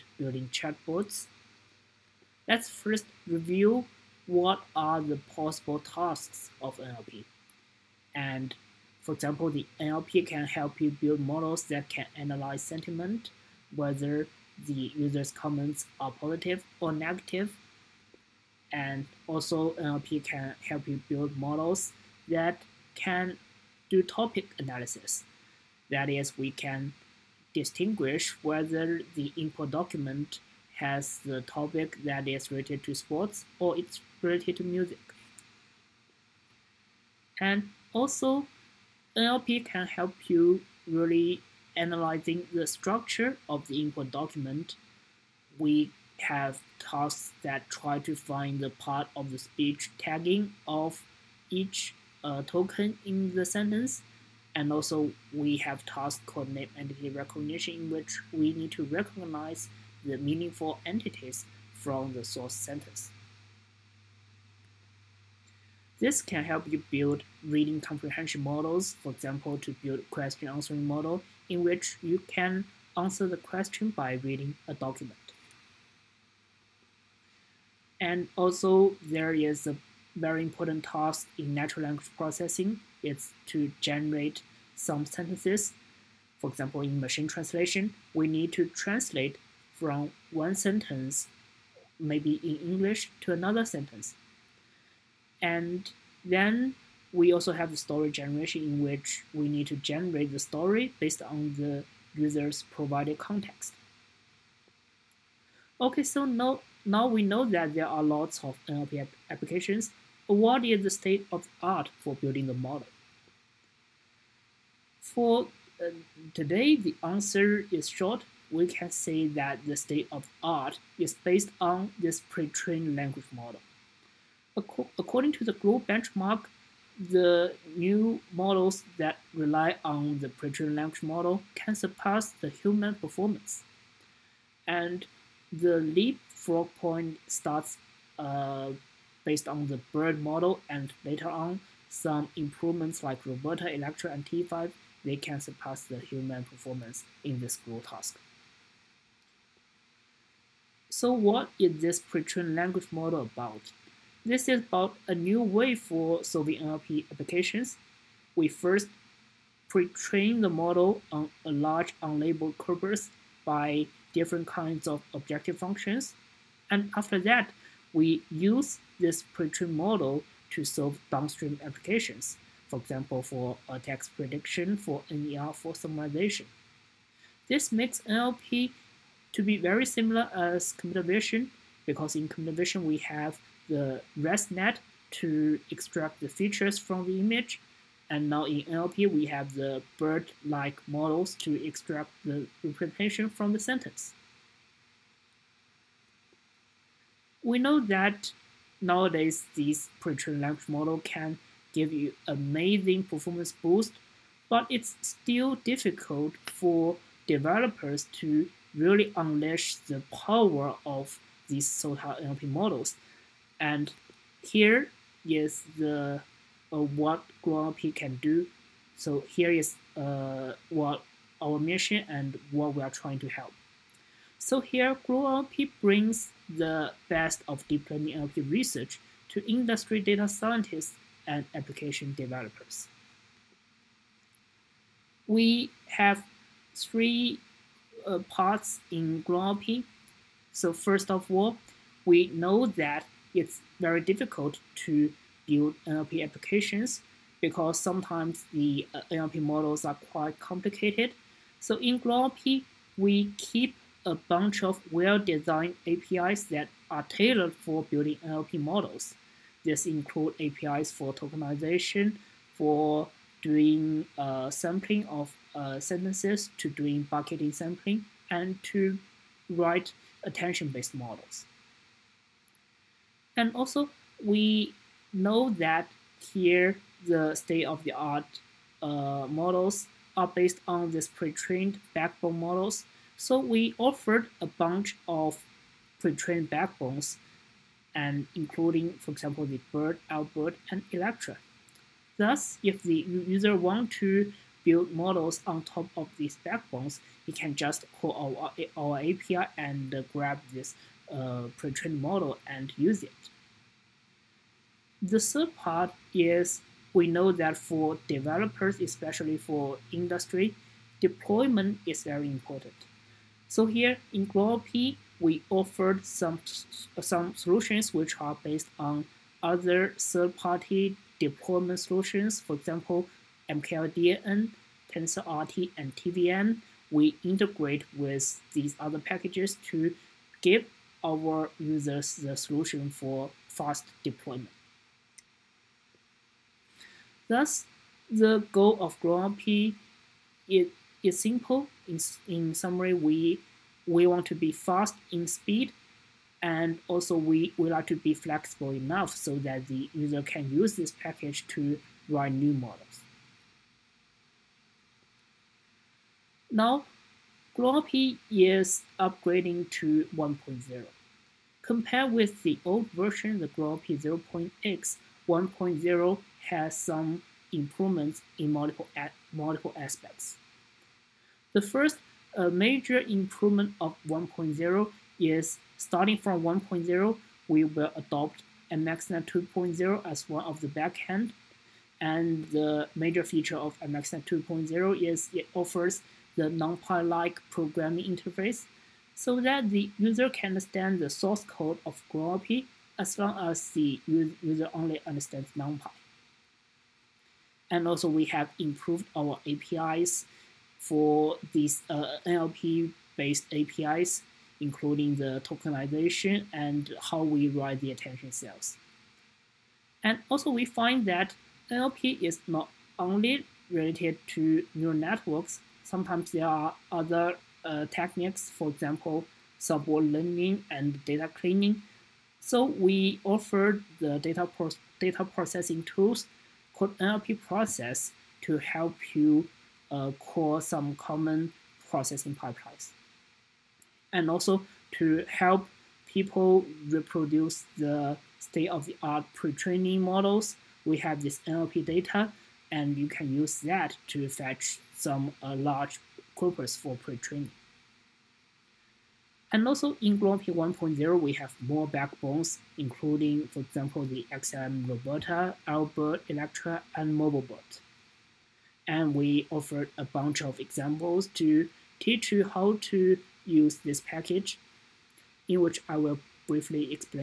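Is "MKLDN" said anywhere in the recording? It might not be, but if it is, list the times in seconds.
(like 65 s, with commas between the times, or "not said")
323 s.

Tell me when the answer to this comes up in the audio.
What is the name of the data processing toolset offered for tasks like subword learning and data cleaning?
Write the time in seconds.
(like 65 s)
426 s.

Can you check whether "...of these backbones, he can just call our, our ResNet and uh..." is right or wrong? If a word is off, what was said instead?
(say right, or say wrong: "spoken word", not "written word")
wrong: "API", not "ResNet".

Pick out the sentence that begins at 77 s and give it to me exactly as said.
And also there is a very important task in natural language processing, it's to generate some sentences.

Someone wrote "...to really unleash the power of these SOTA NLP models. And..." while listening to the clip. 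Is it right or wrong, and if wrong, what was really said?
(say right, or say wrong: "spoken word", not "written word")
right.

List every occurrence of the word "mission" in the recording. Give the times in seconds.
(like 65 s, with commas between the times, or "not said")
221 s.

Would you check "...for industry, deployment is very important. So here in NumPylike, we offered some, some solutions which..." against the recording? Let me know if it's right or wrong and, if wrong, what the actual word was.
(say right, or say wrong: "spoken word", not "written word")
wrong: "GluonNLP", not "NumPylike".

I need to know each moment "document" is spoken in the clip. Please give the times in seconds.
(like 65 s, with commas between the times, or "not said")
29 s, 44 s, 74 s.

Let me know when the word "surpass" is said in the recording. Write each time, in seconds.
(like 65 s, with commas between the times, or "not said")
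131 s, 145 s.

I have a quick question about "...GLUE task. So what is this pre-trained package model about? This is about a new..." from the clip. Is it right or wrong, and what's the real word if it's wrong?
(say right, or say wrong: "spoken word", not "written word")
wrong: "language", not "package".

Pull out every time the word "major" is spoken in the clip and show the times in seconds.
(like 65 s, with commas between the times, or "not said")
372 s, 382 s.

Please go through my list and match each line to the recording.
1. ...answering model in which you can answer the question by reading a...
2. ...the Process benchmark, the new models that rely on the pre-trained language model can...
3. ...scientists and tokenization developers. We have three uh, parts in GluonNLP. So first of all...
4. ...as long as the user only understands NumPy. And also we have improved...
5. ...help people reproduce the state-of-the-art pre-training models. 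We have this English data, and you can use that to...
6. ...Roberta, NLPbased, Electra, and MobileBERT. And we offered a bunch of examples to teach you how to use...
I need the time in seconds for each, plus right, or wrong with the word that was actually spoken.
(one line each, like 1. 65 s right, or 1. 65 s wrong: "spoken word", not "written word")
1. 70 s right
2. 125 s wrong: "GLUE", not "Process"
3. 230 s wrong: "application", not "tokenization"
4. 392 s right
5. 435 s wrong: "NLP", not "English"
6. 454 s wrong: "Albert", not "NLPbased".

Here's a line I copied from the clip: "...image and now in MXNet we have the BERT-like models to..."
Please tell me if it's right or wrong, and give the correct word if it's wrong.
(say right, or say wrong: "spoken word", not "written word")
wrong: "NLP", not "MXNet".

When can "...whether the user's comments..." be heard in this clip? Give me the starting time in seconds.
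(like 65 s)
13 s.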